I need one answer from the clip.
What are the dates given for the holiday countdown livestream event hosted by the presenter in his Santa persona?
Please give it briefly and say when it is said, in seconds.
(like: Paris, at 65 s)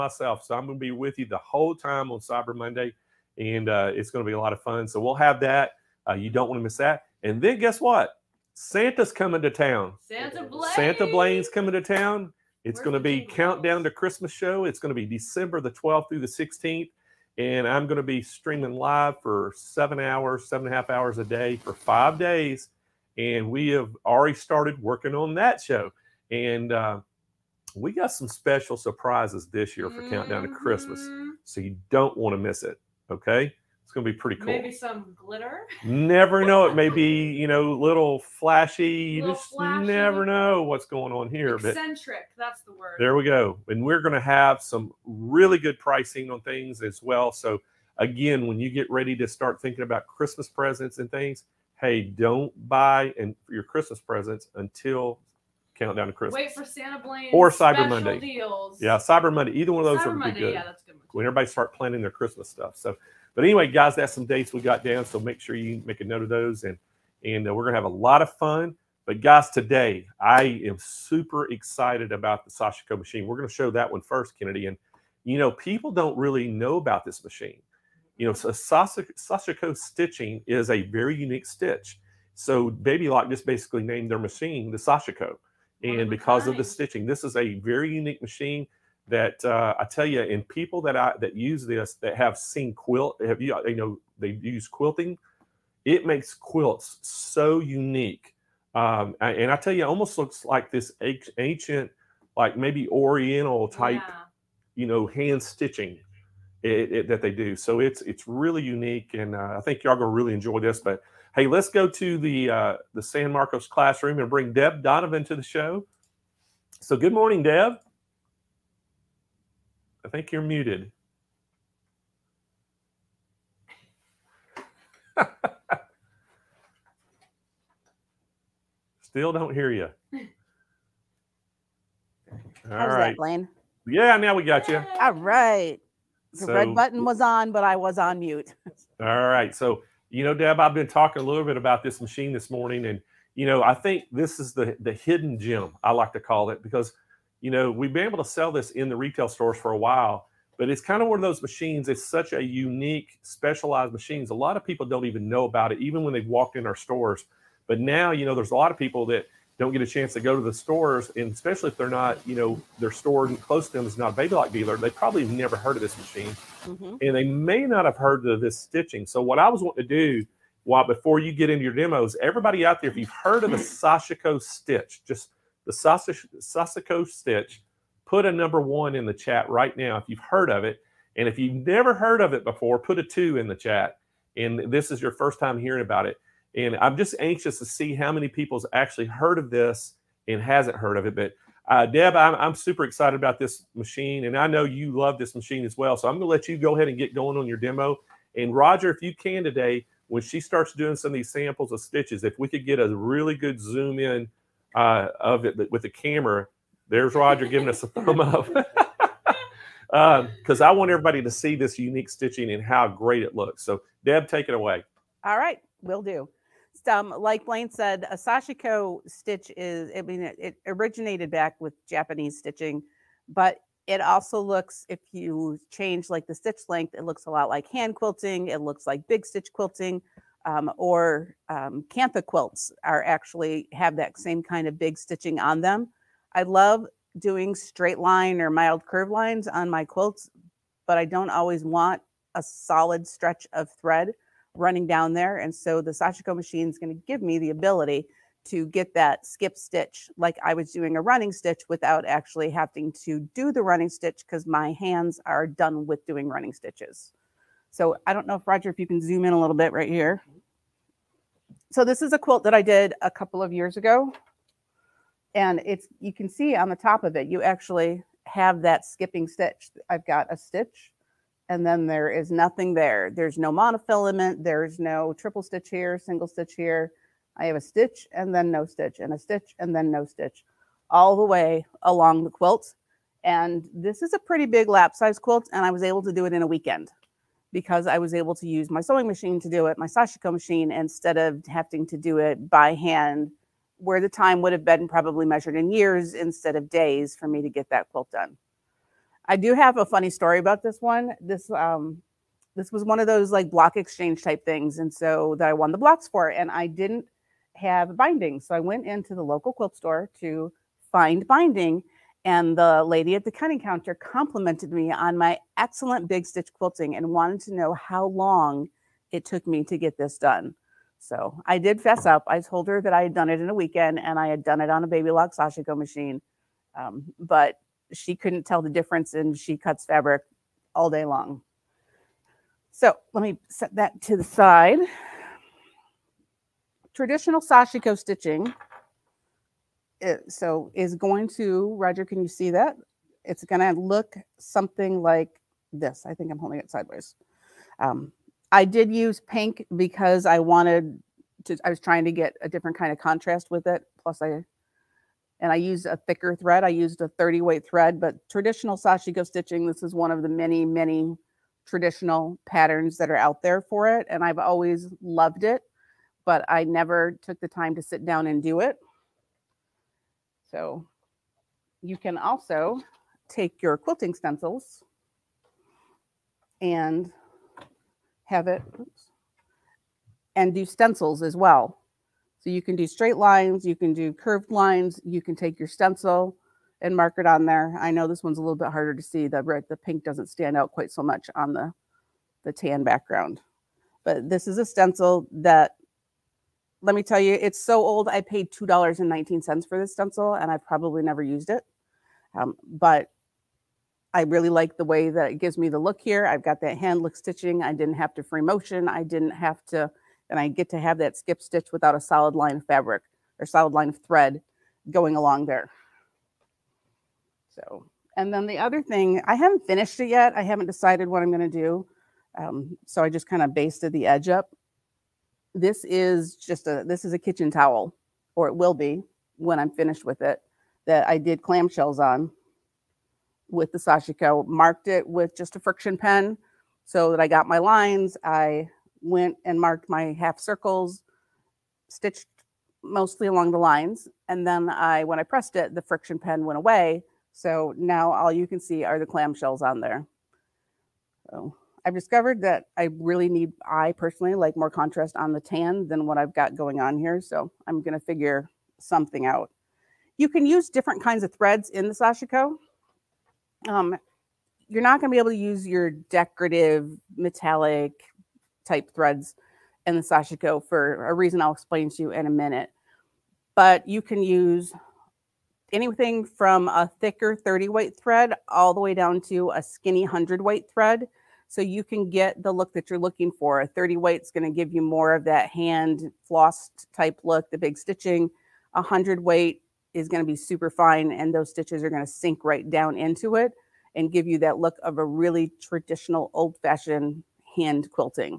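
December 12th through 16th, at 15 s.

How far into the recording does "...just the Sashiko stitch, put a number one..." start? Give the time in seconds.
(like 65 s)
175 s.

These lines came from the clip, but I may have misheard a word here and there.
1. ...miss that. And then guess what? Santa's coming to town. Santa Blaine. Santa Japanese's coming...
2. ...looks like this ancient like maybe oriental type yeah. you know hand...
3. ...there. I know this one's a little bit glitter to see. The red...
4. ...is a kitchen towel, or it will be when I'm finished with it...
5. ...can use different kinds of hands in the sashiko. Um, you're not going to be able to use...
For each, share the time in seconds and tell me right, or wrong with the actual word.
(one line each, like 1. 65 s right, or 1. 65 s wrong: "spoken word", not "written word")
1. 6 s wrong: "Blaine", not "Japanese"
2. 100 s right
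3. 387 s wrong: "harder", not "glitter"
4. 427 s right
5. 460 s wrong: "threads", not "hands".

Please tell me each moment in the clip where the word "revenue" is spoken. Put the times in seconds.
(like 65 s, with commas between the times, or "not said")
not said.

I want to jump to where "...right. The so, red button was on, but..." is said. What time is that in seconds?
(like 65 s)
135 s.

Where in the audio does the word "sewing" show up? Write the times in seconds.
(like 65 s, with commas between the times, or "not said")
288 s.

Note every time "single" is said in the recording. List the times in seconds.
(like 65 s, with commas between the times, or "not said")
275 s.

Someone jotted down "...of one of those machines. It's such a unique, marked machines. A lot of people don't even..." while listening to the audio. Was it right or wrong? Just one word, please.
wrong.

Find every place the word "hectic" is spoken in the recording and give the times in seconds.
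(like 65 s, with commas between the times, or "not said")
not said.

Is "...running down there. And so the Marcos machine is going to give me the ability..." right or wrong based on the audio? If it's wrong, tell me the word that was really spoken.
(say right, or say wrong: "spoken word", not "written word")
wrong: "Sashiko", not "Marcos".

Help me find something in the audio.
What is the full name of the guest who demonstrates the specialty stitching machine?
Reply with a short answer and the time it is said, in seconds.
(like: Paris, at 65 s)
Deb Donovan, at 114 s.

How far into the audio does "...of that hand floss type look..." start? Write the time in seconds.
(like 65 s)
485 s.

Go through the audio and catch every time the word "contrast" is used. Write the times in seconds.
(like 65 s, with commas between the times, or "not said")
352 s, 454 s.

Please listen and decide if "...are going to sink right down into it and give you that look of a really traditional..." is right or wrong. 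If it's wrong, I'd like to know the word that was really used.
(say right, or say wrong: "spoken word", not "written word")
right.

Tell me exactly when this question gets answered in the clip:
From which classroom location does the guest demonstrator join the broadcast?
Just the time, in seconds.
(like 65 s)
113 s.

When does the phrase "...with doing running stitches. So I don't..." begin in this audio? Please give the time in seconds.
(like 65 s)
255 s.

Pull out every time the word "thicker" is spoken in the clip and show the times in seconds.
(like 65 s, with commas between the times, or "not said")
356 s, 477 s.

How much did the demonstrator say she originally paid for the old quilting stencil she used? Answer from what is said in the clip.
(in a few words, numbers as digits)
$2.19.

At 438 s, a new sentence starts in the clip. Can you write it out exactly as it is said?
I went and marked my half circles, stitched mostly along the lines.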